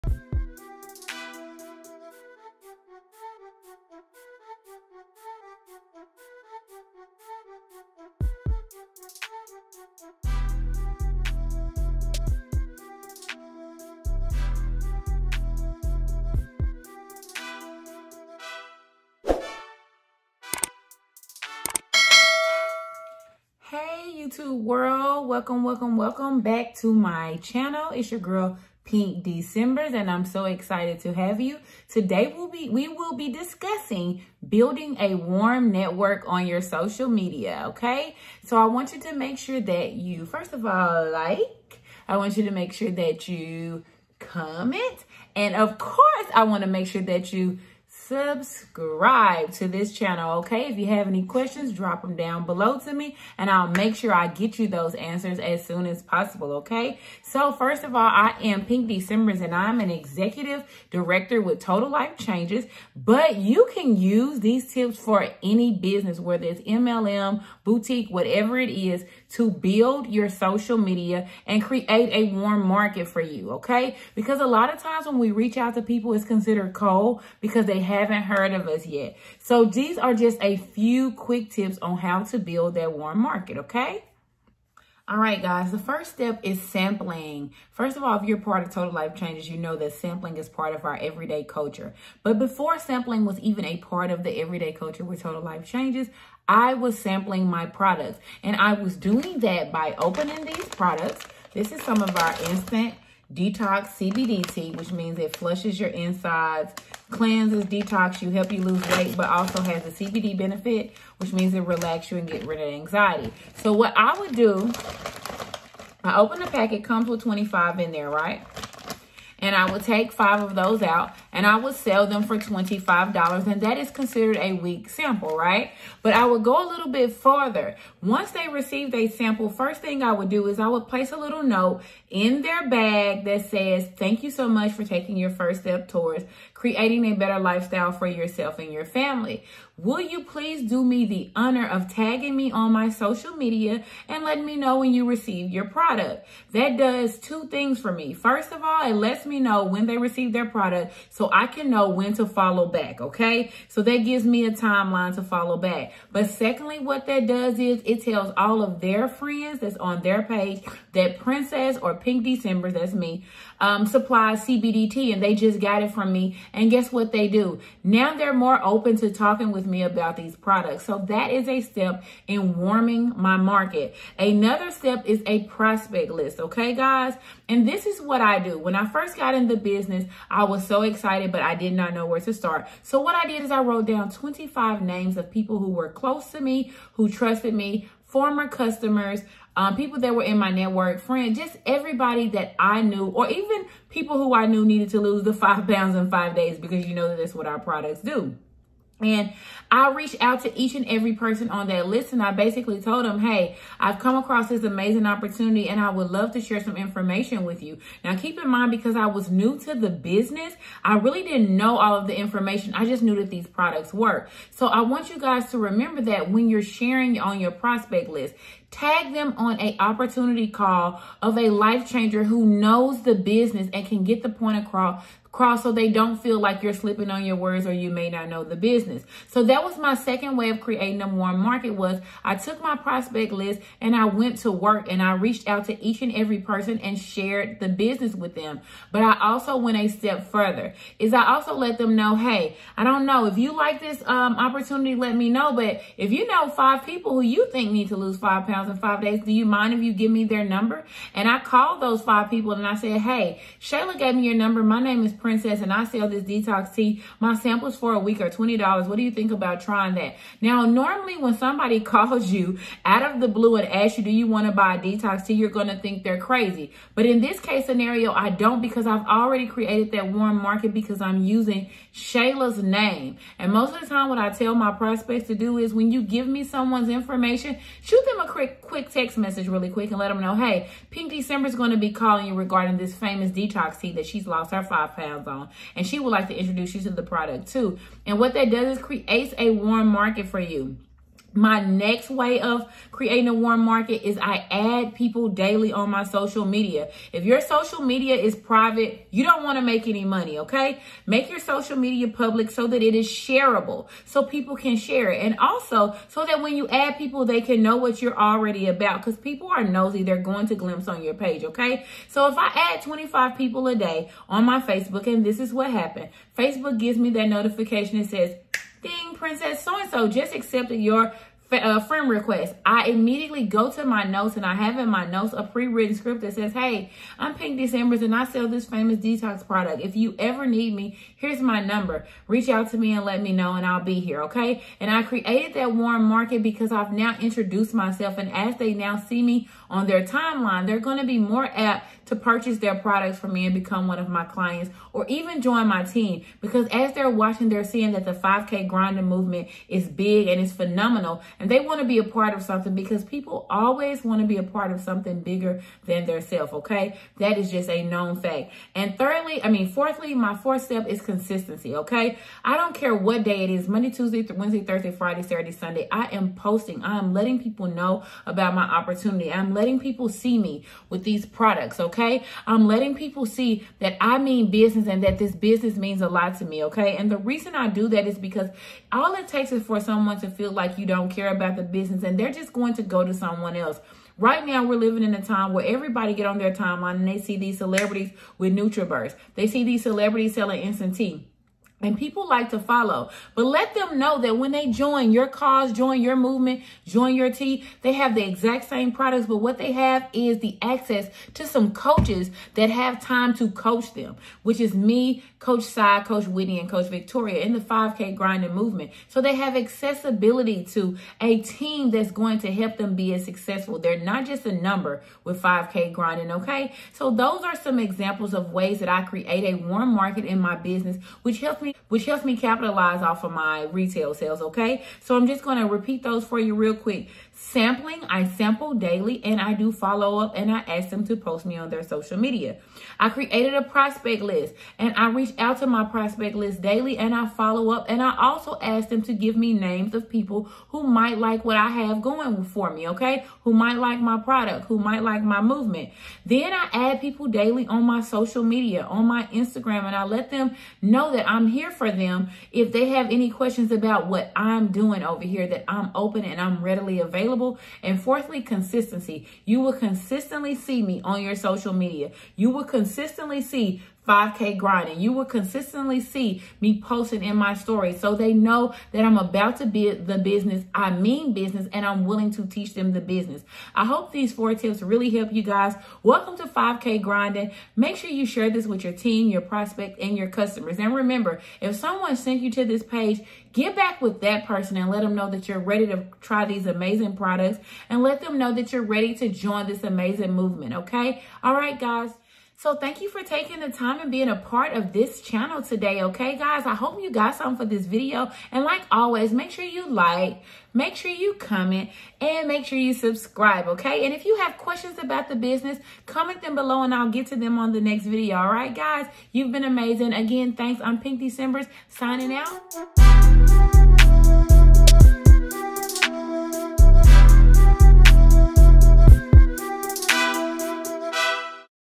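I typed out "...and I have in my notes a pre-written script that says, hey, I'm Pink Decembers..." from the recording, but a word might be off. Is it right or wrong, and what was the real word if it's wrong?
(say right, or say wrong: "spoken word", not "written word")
right.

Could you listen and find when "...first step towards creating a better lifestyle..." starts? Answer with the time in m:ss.
2:15.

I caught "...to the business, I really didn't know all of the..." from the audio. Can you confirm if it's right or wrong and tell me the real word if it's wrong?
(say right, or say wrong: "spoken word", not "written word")
right.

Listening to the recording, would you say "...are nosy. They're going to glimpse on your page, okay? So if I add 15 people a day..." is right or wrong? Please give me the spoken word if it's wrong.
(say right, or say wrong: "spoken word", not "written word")
wrong: "25", not "15".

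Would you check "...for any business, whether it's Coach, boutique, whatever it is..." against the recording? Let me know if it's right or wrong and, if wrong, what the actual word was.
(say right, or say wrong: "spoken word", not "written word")
wrong: "MLM", not "Coach".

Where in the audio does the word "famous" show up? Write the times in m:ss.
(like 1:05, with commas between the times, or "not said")
4:42, 5:28.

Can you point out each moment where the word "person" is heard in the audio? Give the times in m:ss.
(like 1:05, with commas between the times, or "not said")
3:21, 3:56, 8:04.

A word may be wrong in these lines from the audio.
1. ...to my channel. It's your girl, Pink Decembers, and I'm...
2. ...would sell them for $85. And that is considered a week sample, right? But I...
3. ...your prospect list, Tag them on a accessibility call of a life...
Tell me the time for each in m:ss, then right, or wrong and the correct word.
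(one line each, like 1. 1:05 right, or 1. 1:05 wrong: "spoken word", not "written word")
1. 0:26 right
2. 2:01 wrong: "25", not "85"
3. 3:37 wrong: "opportunity", not "accessibility".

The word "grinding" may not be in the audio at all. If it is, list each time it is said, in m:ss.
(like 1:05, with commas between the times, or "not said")
5:48, 6:48, 6:55, 7:44, 7:57.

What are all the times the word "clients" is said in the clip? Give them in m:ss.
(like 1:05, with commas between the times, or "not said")
5:44.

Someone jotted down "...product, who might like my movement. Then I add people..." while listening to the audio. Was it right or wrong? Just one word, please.
right.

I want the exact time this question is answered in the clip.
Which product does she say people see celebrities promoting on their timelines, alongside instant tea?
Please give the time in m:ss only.
6:28.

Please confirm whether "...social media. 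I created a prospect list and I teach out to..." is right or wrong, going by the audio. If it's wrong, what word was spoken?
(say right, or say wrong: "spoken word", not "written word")
wrong: "reach", not "teach".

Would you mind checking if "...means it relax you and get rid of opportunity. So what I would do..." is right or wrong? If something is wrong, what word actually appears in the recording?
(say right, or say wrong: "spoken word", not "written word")
wrong: "anxiety", not "opportunity".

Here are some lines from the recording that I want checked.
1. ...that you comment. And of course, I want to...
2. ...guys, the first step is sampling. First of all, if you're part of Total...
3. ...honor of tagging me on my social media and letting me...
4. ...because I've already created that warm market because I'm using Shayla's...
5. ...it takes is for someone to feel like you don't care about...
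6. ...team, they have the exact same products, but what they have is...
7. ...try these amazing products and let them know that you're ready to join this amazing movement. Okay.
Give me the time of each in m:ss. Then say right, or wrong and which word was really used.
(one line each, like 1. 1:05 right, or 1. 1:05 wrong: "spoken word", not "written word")
1. 0:42 right
2. 1:25 right
3. 2:21 right
4. 4:28 right
5. 6:19 right
6. 6:37 right
7. 8:06 right.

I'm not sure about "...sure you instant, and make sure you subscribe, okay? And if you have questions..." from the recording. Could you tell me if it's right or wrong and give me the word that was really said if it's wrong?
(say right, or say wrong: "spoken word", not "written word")
wrong: "comment", not "instant".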